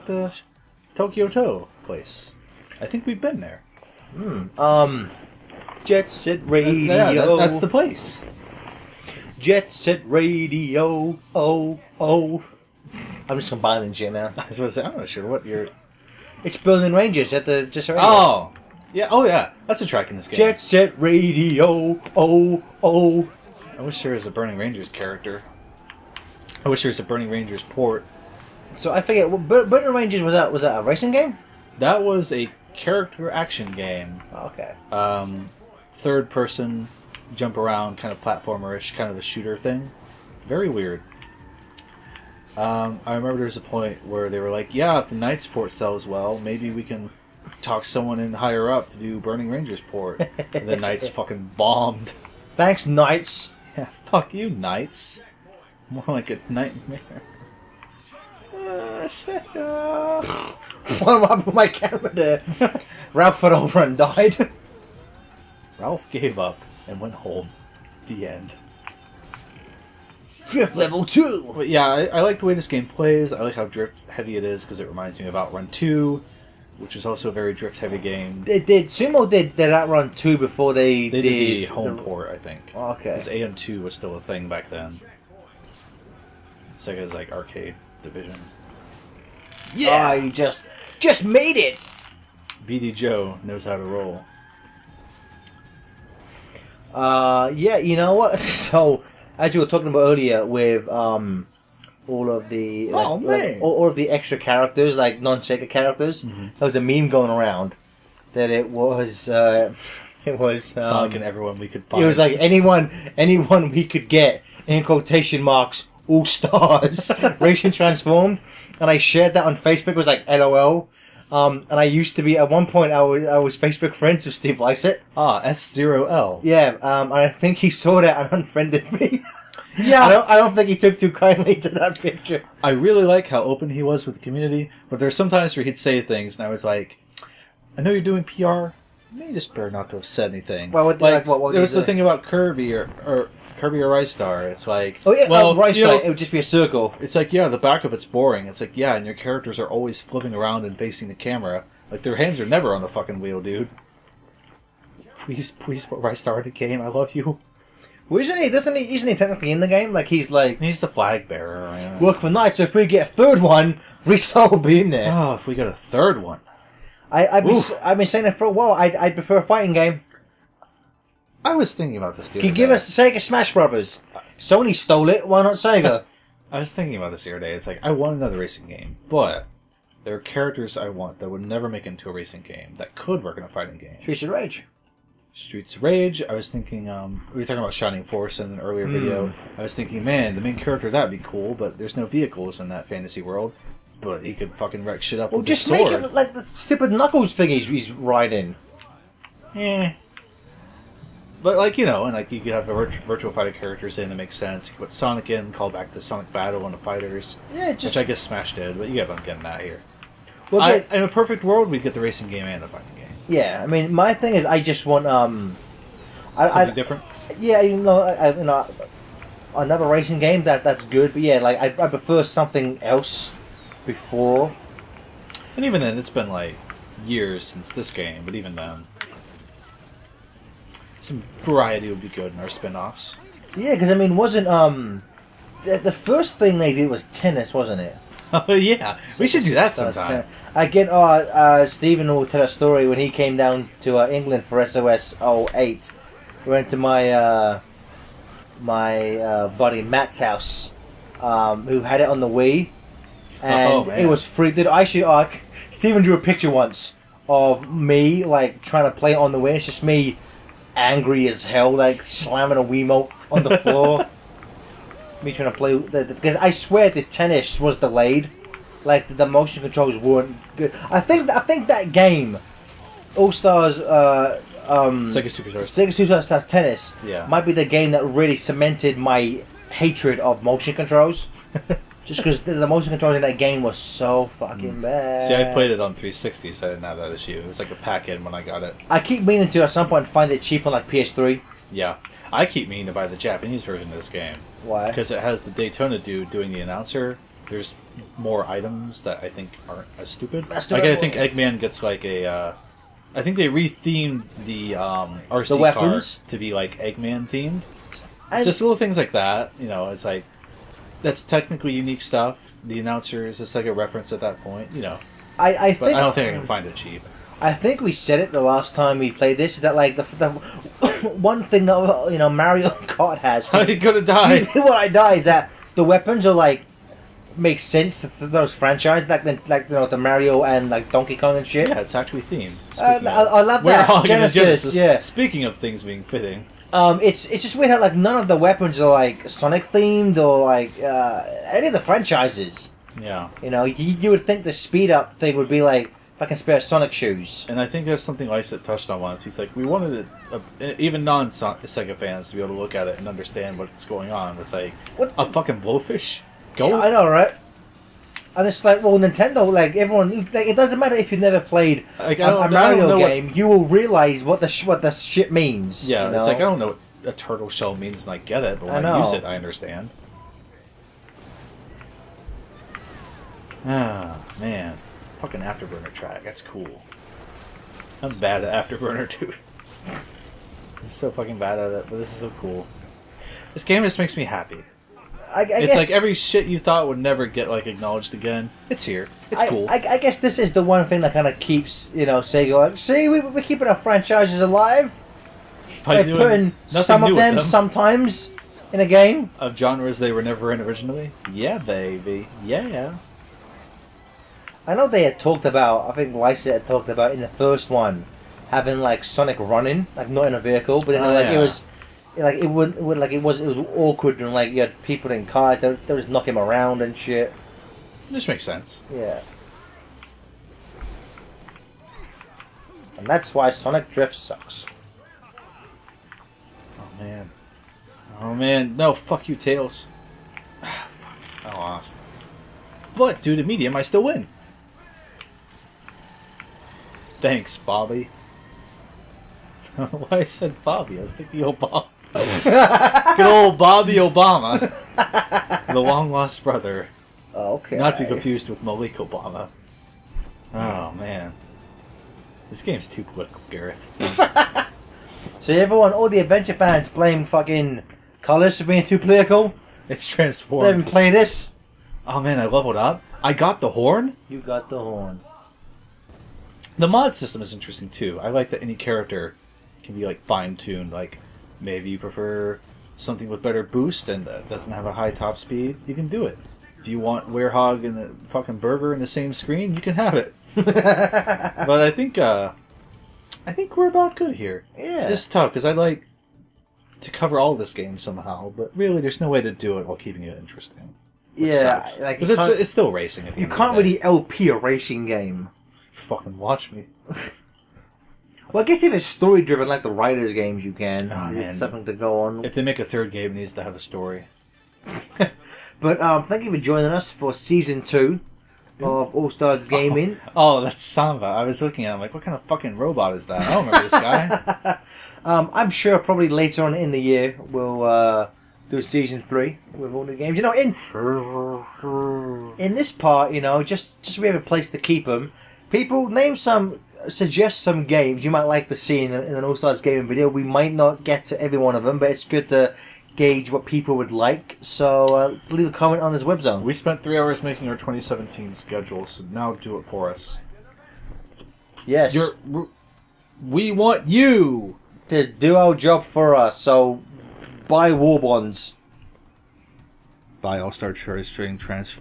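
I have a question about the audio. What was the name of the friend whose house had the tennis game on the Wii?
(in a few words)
Matt.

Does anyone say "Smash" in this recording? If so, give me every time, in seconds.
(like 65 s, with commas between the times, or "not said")
173 s, 208 s.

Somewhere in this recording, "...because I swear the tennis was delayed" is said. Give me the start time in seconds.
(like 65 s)
265 s.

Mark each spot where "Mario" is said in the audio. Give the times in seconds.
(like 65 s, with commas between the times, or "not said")
322 s, 329 s, 362 s.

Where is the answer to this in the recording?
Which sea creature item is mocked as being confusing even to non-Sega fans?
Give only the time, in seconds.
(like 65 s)
355 s.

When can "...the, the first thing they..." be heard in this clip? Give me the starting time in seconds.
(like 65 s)
235 s.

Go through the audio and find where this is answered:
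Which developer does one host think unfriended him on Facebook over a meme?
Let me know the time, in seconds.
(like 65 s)
124 s.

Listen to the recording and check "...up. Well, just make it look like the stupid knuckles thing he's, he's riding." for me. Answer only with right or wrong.
right.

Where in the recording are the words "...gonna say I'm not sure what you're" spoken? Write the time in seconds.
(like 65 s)
14 s.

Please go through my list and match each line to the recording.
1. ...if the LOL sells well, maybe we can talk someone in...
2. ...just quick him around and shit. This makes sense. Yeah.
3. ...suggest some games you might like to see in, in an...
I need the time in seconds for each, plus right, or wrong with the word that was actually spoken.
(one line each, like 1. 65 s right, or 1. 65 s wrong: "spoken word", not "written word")
1. 44 s wrong: "Knightsport", not "LOL"
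2. 415 s wrong: "knock", not "quick"
3. 527 s right.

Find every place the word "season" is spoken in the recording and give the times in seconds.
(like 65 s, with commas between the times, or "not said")
507 s, 518 s.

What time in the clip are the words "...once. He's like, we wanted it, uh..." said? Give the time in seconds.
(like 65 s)
349 s.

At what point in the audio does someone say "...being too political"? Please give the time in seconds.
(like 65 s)
458 s.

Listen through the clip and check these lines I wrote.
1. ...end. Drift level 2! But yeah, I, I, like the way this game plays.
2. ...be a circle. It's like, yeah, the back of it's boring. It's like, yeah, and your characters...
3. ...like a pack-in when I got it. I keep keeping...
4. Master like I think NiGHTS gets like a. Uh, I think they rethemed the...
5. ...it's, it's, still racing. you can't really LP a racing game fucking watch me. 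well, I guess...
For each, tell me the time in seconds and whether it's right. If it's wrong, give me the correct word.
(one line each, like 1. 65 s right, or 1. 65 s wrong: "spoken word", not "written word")
1. 68 s right
2. 146 s right
3. 287 s wrong: "meaning", not "keeping"
4. 300 s wrong: "Eggman", not "NiGHTS"
5. 492 s right.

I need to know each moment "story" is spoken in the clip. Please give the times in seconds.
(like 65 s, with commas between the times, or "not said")
242 s, 499 s, 503 s.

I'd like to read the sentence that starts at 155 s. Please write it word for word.
Please, please put Ristar in the game.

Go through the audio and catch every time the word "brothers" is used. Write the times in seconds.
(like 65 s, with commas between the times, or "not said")
173 s, 446 s.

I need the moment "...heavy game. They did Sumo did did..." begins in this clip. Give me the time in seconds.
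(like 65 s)
77 s.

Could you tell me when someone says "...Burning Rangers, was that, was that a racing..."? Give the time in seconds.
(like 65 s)
29 s.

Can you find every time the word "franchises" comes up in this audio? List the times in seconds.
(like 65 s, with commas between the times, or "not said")
328 s, 341 s, 393 s.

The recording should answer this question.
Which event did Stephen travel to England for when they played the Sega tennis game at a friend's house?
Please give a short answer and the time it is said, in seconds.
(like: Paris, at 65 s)
SOS 08, at 244 s.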